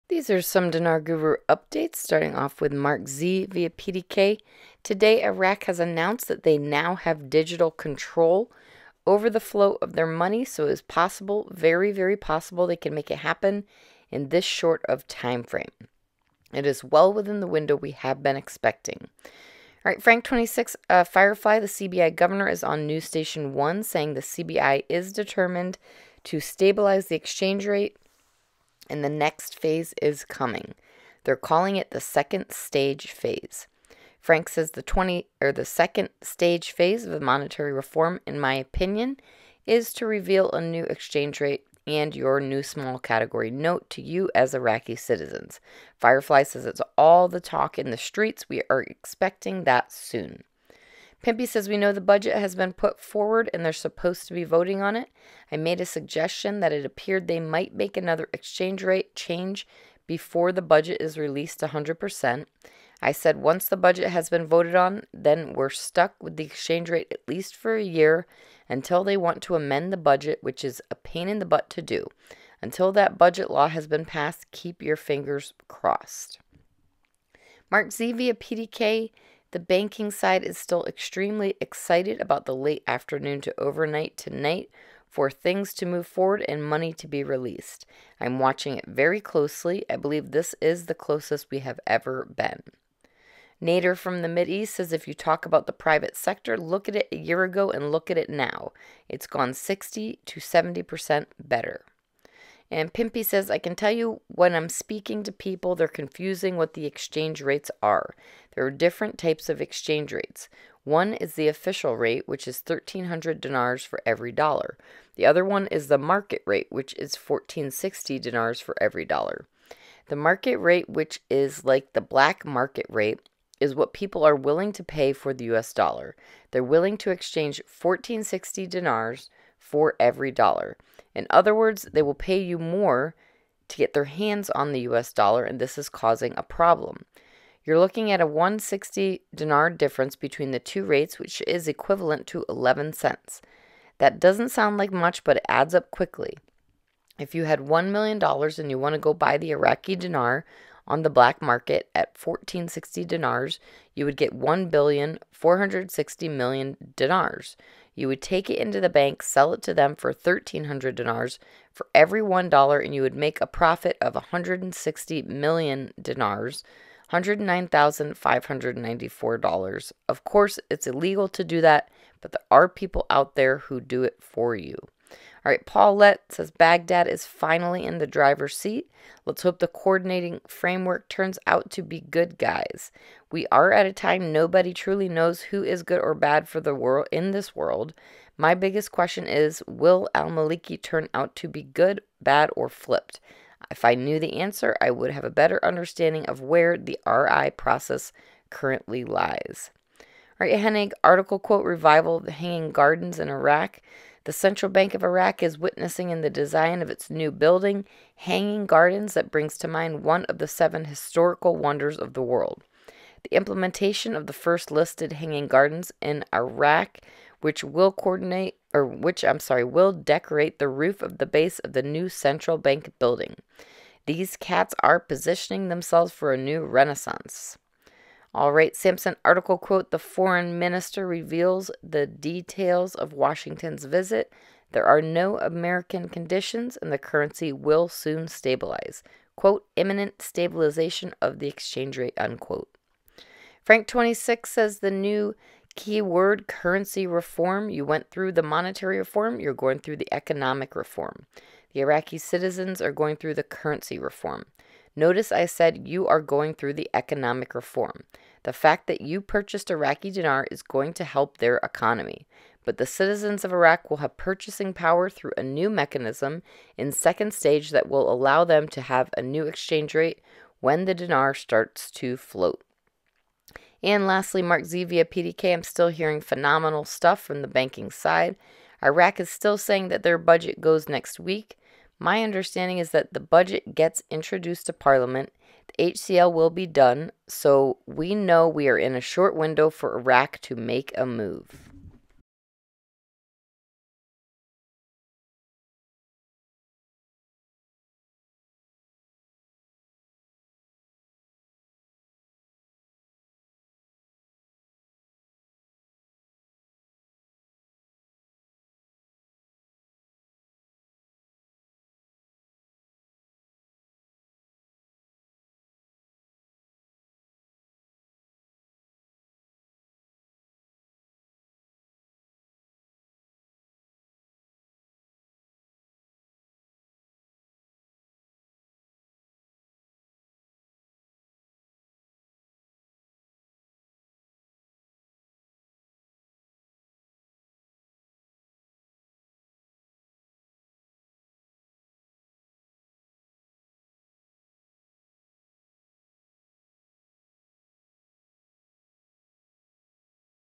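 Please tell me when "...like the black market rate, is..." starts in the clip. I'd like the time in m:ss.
2:01.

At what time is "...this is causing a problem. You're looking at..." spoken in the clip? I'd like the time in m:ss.
2:15.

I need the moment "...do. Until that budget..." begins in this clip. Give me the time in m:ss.
1:11.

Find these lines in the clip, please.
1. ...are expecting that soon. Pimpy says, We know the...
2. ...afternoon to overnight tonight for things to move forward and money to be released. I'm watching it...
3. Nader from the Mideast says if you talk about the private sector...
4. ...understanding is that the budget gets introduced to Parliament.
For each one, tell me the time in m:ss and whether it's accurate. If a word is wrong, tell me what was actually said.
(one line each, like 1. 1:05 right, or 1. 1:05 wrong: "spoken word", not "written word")
1. 0:48 right
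2. 1:22 right
3. 1:33 right
4. 4:42 right.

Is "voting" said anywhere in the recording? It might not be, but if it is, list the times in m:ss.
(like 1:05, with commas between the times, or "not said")
0:54.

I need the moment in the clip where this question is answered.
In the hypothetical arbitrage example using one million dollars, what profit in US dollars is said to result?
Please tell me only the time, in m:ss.
2:47.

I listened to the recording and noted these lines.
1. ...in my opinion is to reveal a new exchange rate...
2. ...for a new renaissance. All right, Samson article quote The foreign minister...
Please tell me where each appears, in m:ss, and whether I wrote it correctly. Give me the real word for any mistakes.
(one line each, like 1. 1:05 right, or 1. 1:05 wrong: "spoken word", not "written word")
1. 0:38 right
2. 3:46 right.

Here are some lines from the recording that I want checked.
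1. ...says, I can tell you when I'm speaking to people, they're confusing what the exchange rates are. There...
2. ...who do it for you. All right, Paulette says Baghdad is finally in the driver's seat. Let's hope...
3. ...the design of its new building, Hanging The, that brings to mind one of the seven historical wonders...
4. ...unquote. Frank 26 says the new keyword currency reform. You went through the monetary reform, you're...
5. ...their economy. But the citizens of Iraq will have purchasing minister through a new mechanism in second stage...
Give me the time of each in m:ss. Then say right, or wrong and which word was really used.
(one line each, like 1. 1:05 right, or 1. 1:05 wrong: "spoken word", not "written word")
1. 1:43 right
2. 2:53 right
3. 3:26 wrong: "Gardens", not "The"
4. 4:02 right
5. 4:21 wrong: "power", not "minister".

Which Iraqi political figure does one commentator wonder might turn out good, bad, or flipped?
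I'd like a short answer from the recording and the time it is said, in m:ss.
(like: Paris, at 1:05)
Al Maliki, at 3:10.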